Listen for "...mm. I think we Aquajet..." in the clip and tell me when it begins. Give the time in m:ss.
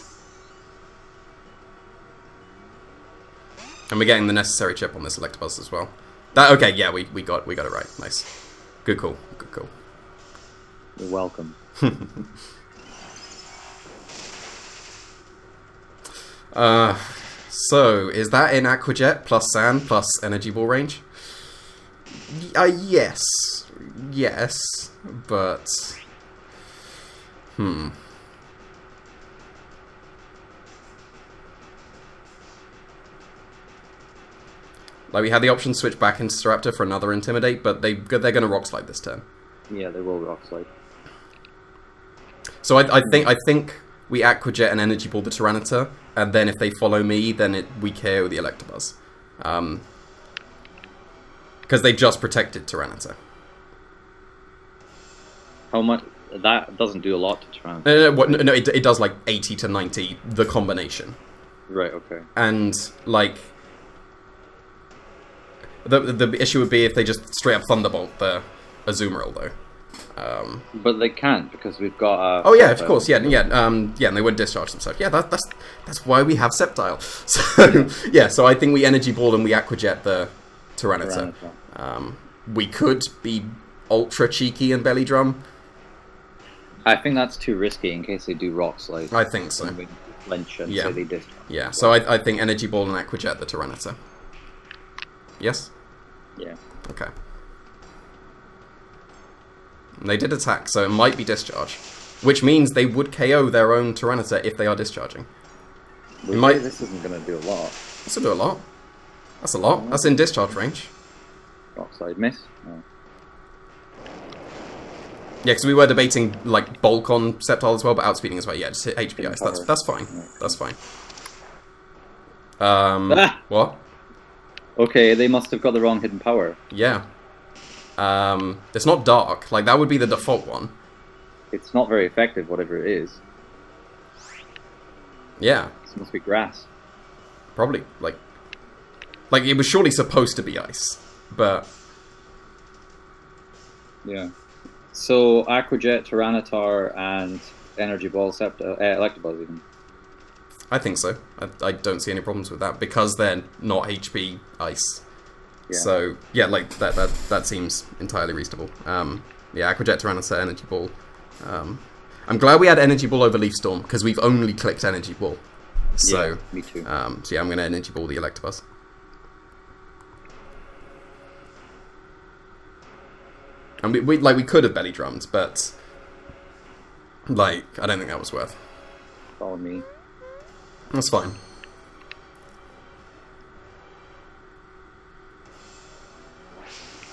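0:43.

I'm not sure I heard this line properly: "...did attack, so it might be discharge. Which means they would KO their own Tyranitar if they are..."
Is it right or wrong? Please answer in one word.
right.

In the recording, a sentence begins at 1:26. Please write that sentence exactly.
I think that's too risky in case they do rock slide.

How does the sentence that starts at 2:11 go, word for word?
It's not very effective, whatever it is.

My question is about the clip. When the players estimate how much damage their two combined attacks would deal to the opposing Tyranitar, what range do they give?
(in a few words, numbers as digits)
80 to 90.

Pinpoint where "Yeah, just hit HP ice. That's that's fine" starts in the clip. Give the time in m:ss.
1:58.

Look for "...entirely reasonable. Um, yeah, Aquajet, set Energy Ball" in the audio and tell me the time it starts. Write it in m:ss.
2:37.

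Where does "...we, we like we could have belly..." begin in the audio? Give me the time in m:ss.
2:53.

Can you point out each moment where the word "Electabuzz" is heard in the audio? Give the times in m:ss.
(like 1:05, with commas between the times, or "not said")
0:05, 0:48, 2:28, 2:48.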